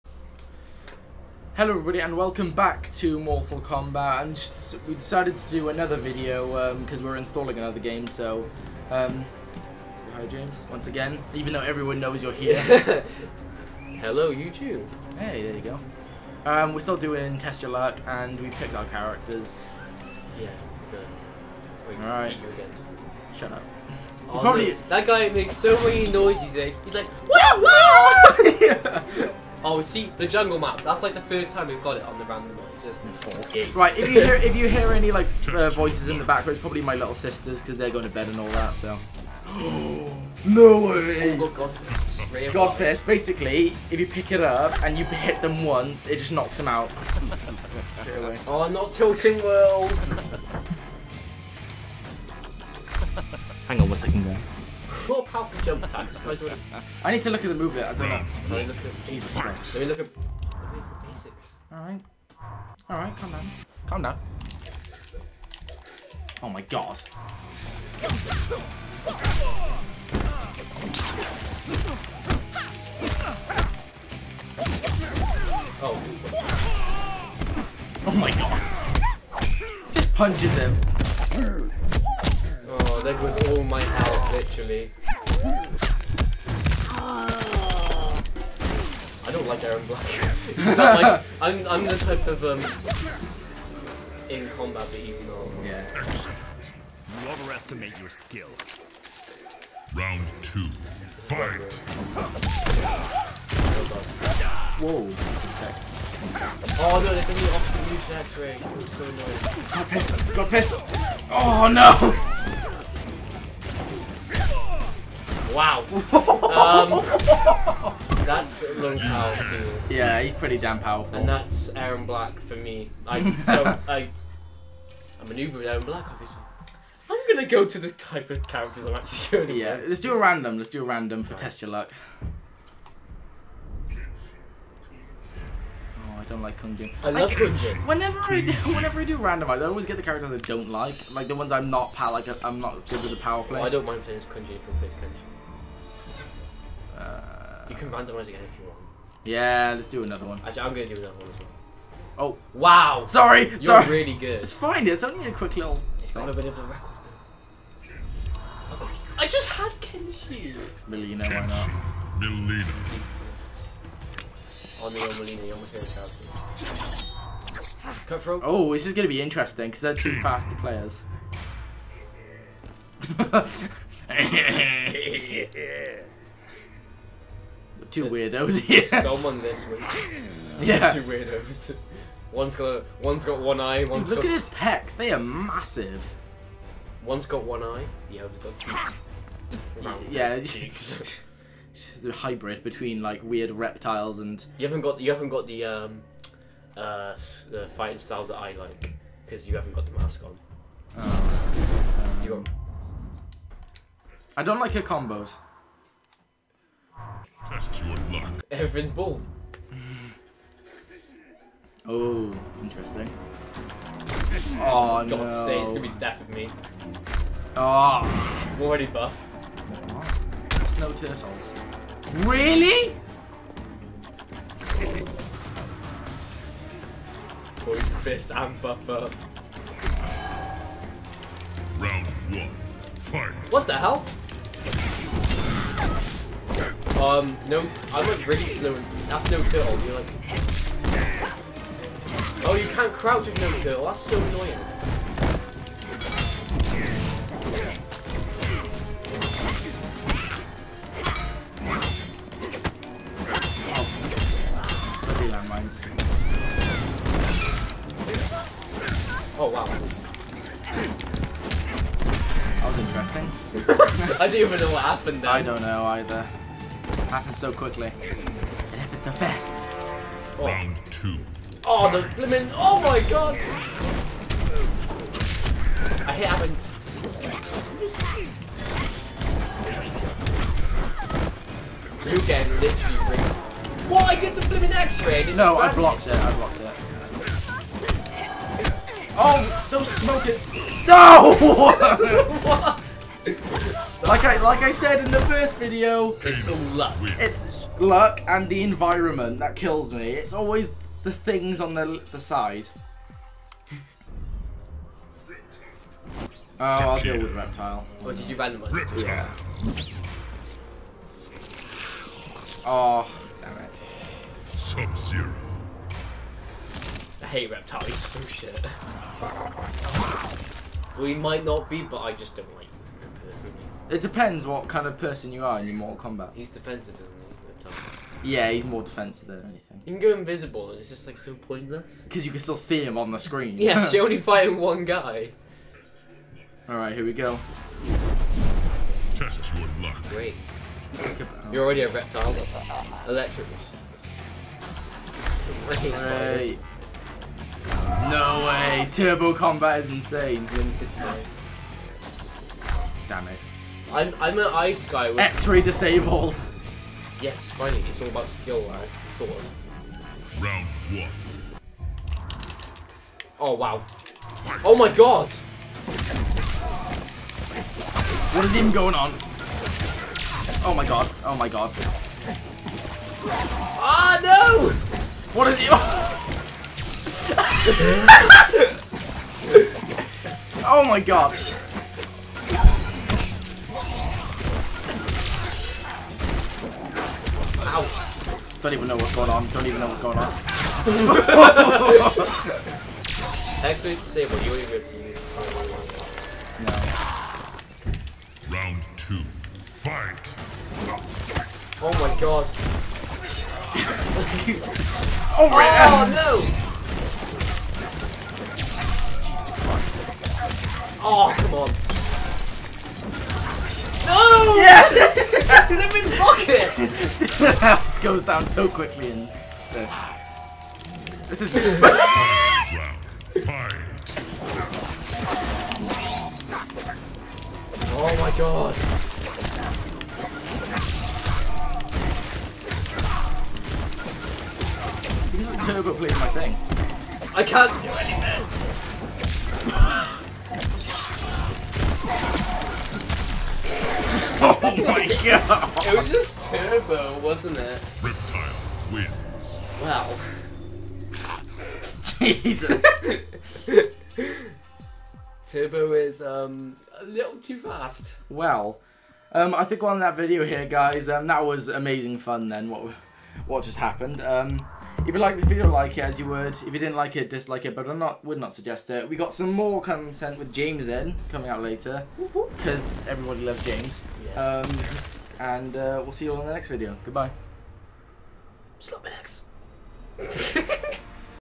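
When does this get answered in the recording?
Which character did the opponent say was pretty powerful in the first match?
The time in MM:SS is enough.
01:58.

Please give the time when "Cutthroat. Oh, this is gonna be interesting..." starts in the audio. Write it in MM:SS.
02:48.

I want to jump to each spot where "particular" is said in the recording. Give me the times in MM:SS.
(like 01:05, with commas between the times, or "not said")
not said.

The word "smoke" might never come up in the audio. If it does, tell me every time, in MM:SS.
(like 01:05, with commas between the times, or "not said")
04:49.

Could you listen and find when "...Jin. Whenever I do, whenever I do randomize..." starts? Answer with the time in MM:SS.
02:17.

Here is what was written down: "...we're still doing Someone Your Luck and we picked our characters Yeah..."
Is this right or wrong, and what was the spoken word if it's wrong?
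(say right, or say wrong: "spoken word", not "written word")
wrong: "Test", not "Someone".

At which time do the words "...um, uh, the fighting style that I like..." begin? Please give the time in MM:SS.
03:15.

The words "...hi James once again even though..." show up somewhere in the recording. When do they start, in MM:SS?
00:10.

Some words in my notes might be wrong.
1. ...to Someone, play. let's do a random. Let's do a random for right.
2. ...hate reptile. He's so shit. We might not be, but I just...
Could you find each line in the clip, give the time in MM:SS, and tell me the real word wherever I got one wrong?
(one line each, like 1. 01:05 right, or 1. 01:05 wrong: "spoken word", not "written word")
1. 02:09 wrong: "Yeah", not "Someone"
2. 05:17 right.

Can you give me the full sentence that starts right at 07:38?
Well, um, I think we're on that video here, guys.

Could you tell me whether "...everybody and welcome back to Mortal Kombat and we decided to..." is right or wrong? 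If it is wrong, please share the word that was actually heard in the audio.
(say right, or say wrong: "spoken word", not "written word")
right.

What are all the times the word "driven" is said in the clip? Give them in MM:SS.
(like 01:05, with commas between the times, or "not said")
not said.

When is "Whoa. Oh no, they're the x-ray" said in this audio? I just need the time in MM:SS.
01:44.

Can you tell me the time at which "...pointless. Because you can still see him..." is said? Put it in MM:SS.
05:31.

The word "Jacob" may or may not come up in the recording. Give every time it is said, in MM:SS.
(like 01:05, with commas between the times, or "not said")
not said.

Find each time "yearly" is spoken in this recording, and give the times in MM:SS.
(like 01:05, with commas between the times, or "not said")
not said.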